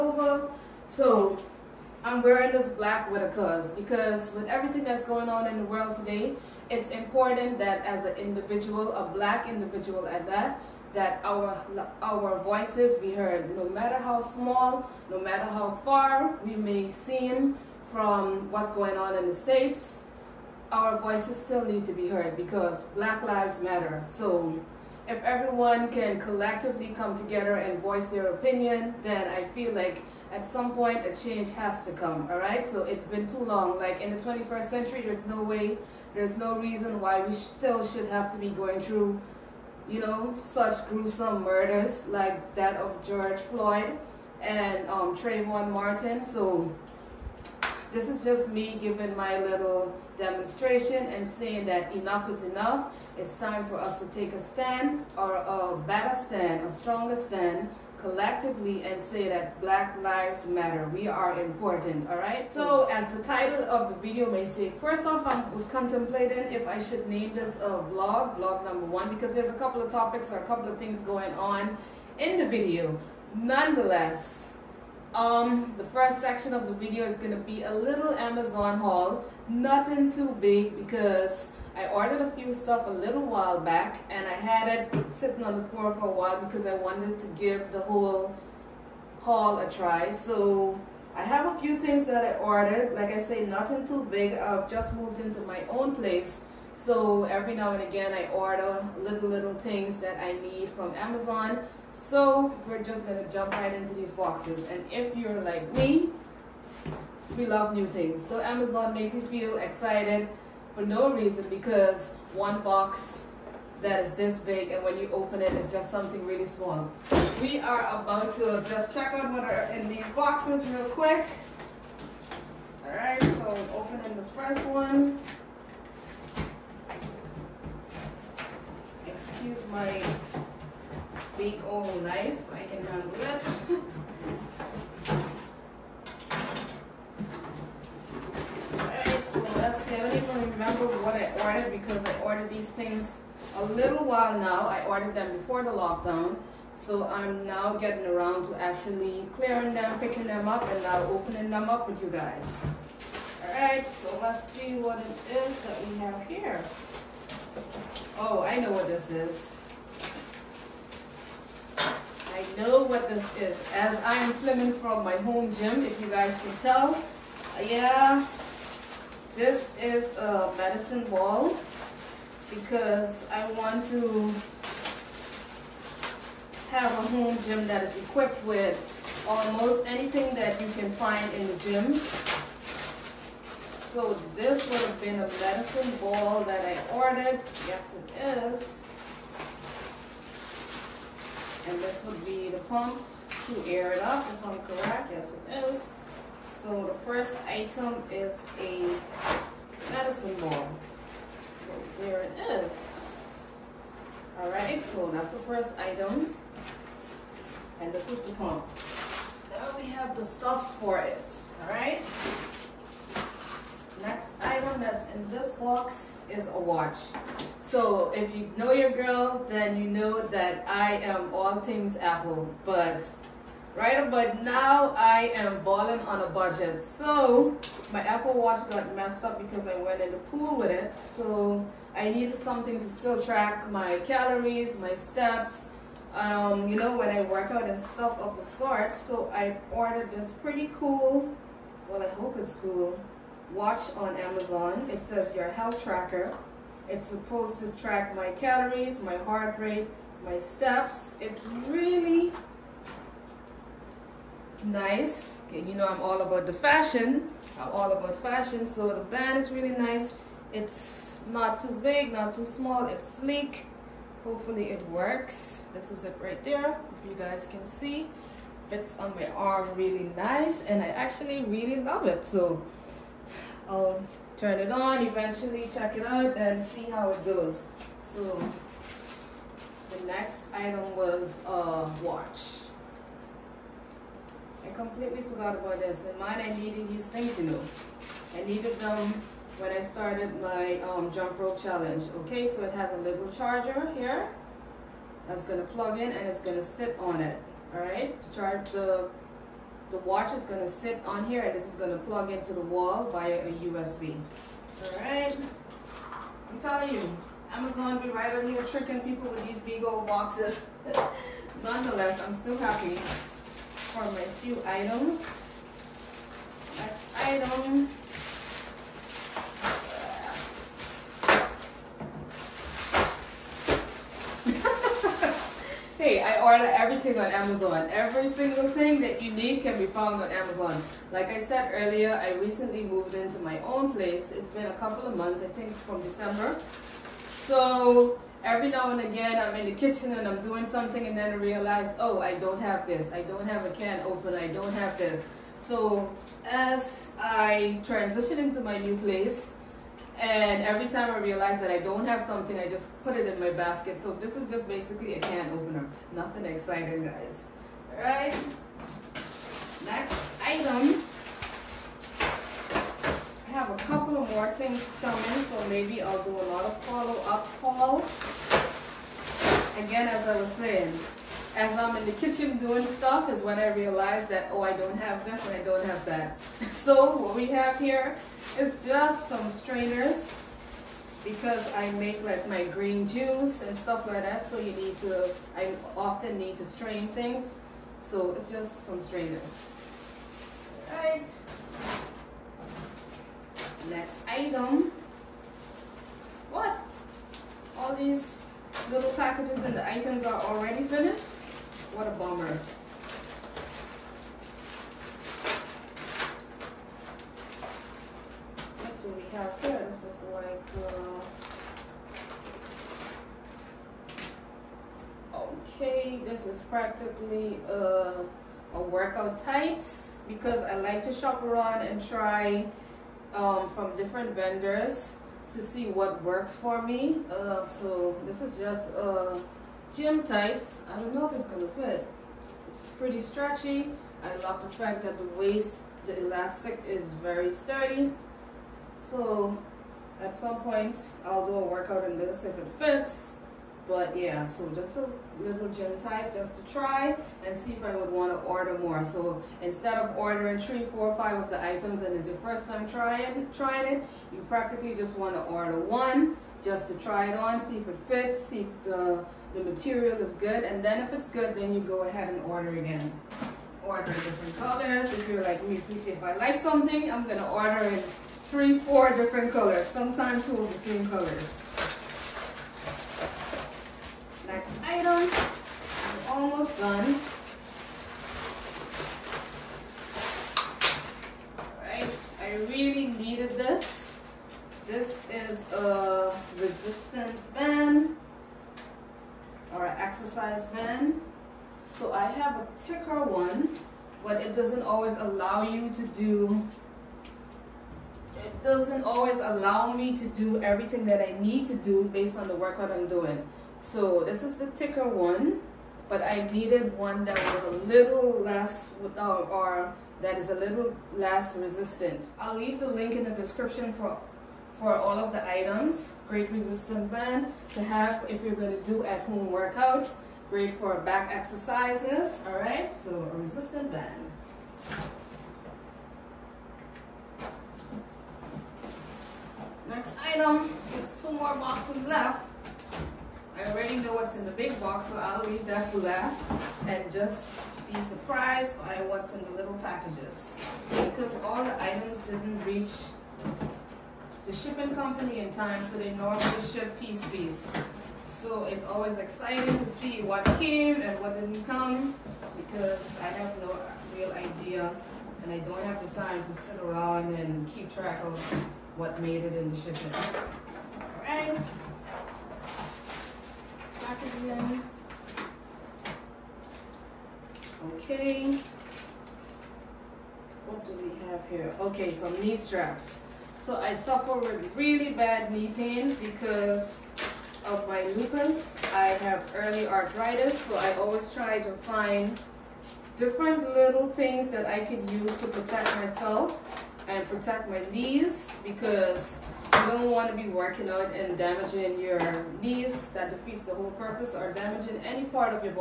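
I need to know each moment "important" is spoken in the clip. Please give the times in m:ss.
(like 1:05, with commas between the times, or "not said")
0:06, 1:01.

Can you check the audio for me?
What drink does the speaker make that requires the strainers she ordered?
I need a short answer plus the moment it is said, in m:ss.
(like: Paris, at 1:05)
Green juice, at 6:22.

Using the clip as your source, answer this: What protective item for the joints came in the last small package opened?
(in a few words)
Knee straps.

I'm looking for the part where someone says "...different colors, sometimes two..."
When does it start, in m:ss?
7:49.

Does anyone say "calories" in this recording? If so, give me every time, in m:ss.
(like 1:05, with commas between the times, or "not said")
3:53, 4:08.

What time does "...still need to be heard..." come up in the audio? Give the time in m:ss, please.
0:21.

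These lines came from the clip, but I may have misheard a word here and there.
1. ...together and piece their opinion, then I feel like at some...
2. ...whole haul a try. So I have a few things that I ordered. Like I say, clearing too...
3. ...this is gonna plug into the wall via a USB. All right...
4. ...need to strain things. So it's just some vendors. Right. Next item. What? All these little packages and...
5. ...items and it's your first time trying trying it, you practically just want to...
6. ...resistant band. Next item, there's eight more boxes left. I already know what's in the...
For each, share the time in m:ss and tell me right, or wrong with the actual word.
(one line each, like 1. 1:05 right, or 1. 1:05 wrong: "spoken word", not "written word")
1. 0:27 wrong: "voice", not "piece"
2. 1:27 wrong: "nothing", not "clearing"
3. 5:01 right
4. 6:26 wrong: "strainers", not "vendors"
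5. 7:31 right
6. 8:43 wrong: "two", not "eight".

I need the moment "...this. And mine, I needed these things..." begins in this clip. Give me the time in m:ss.
4:45.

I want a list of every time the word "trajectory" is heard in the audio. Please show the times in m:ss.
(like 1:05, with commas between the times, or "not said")
not said.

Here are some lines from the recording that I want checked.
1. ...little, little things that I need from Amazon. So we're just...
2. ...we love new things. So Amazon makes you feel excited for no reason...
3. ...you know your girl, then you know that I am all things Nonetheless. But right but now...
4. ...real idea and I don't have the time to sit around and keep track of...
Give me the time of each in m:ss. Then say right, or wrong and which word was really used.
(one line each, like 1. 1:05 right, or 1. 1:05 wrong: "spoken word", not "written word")
1. 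1:38 right
2. 1:47 right
3. 3:38 wrong: "Apple", not "Nonetheless"
4. 9:14 right.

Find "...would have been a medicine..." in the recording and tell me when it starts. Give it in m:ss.
3:04.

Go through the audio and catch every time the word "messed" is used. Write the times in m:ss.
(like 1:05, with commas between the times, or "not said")
3:48.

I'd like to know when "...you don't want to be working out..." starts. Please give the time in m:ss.
9:49.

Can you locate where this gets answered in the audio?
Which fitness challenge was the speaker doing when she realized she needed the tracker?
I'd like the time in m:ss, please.
4:51.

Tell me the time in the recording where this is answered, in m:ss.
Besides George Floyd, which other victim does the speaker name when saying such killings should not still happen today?
0:45.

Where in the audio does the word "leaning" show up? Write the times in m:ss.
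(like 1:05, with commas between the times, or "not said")
not said.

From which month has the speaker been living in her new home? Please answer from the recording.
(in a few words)
December.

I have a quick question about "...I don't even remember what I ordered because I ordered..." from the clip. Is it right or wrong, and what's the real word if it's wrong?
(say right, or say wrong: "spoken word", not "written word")
right.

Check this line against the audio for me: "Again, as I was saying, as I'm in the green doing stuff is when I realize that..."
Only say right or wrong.
wrong.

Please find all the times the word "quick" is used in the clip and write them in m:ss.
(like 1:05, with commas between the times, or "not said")
2:00.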